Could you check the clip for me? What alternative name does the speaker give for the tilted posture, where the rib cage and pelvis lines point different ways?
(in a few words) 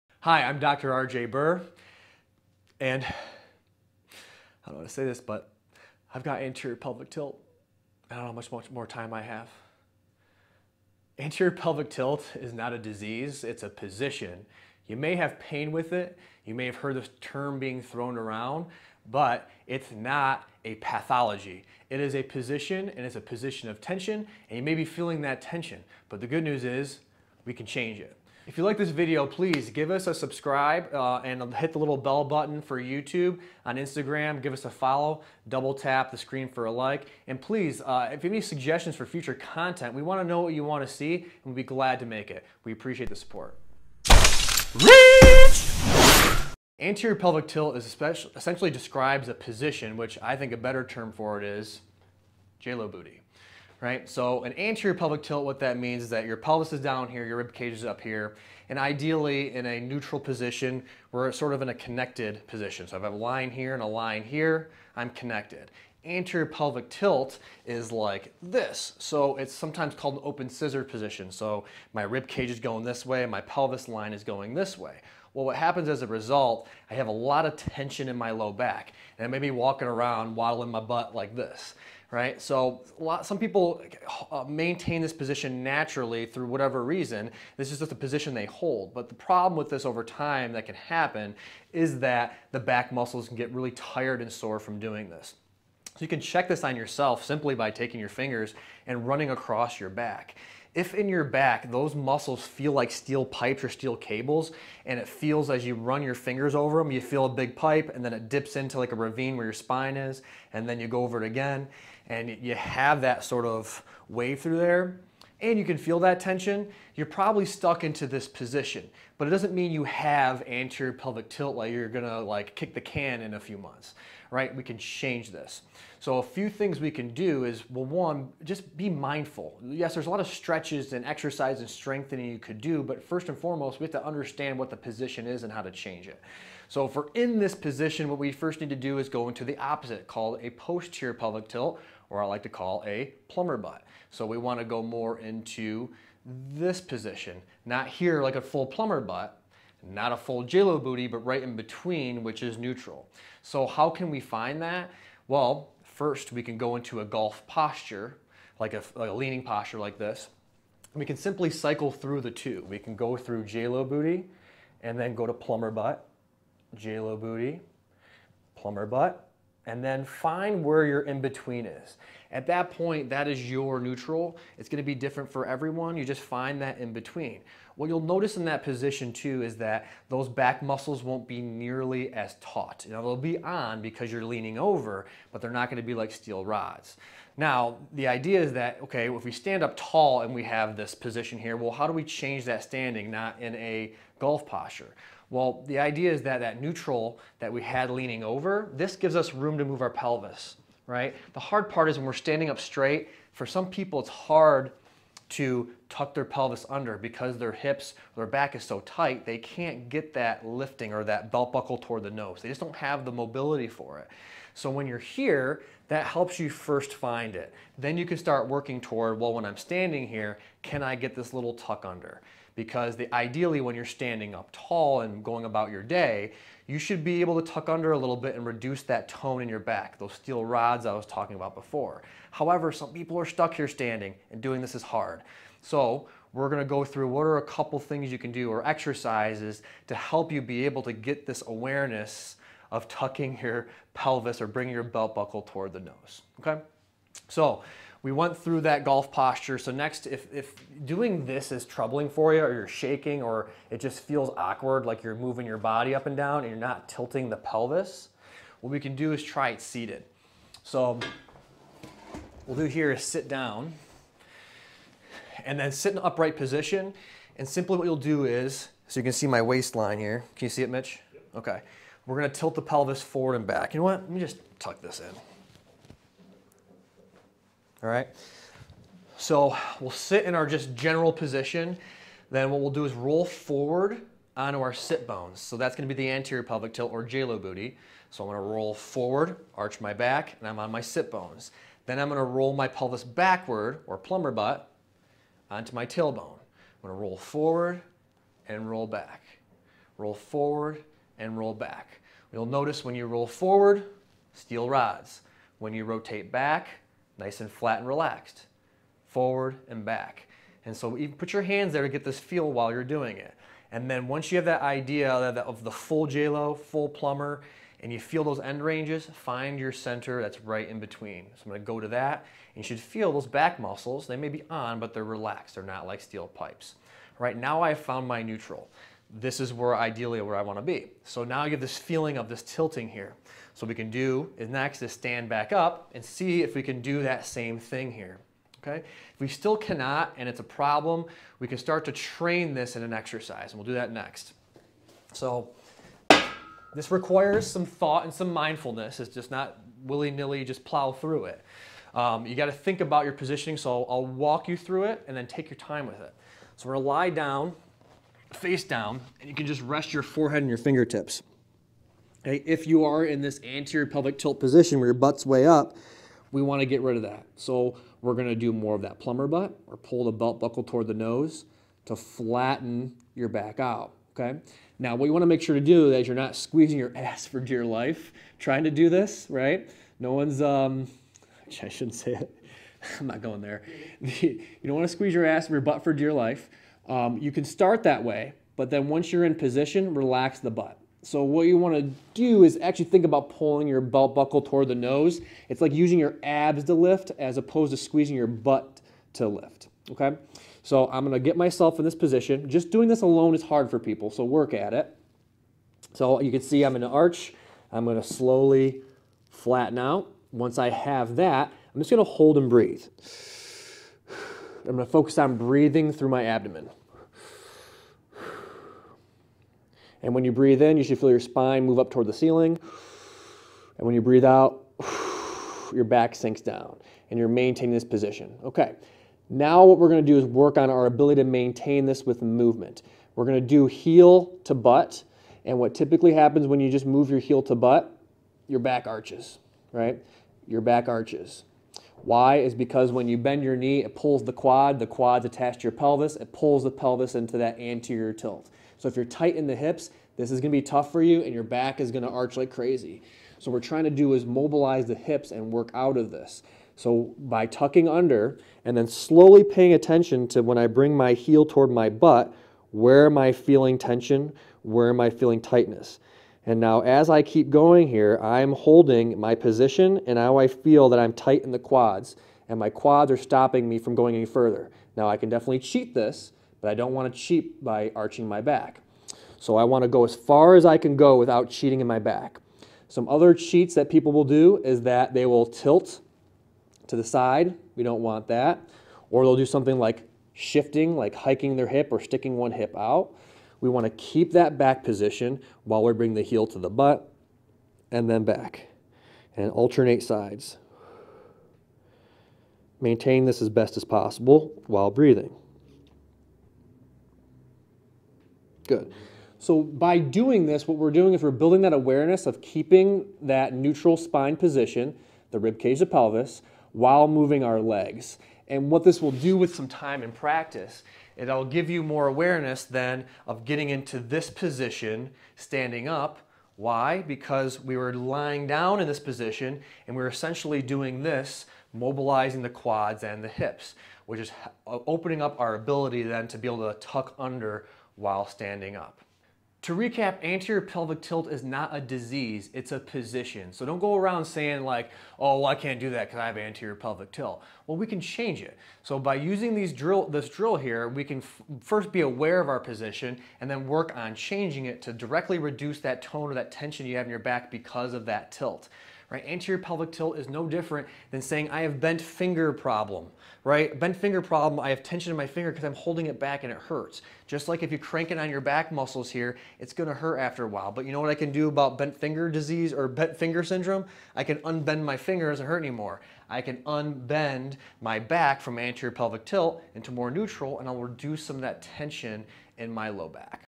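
open scissor position.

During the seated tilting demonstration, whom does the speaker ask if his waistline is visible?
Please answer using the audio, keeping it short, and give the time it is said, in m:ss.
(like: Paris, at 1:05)
Mitch, at 4:30.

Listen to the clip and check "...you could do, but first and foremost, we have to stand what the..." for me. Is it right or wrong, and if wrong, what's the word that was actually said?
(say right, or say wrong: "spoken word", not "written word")
wrong: "understand", not "stand".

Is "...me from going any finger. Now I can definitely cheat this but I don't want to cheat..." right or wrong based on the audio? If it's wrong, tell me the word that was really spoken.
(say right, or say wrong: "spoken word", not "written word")
wrong: "further", not "finger".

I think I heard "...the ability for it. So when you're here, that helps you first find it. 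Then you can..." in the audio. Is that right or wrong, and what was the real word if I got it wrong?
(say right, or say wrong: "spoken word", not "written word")
wrong: "mobility", not "ability".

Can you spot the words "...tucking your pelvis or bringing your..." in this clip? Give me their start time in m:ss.
4:02.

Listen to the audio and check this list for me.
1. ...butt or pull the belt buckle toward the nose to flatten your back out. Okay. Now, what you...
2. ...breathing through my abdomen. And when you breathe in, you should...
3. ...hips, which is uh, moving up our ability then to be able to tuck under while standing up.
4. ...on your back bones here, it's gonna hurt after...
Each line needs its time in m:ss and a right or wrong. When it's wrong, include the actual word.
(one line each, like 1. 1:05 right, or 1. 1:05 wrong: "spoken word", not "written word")
1. 6:09 right
2. 6:55 right
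3. 8:53 wrong: "opening", not "moving"
4. 9:28 wrong: "muscles", not "bones".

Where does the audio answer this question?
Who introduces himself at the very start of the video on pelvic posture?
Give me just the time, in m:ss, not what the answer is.
0:00.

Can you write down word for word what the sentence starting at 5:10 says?
And so you put your hands there to get this feel while you're doing it.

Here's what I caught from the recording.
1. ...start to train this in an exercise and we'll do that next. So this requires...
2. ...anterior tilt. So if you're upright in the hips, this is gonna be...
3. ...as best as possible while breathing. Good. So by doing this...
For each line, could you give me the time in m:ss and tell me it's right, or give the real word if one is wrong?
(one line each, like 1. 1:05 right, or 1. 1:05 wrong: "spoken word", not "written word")
1. 5:41 right
2. 7:27 wrong: "tight", not "upright"
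3. 8:23 right.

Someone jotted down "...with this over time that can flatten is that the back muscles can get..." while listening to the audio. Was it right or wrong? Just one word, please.
wrong.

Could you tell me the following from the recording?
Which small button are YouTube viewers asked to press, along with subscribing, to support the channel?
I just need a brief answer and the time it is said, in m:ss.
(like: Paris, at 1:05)
bell button, at 0:31.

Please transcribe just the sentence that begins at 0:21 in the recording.
It is a position and it's a position of tension, and you may be feeling that tension.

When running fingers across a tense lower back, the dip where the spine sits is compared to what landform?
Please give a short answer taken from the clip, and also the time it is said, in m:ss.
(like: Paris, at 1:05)
ravine, at 1:48.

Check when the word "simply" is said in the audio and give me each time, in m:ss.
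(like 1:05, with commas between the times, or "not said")
1:37, 2:41, 4:27.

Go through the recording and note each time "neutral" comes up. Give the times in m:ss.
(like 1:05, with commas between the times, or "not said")
0:59, 2:32, 2:53, 3:16, 5:28, 8:33, 9:40.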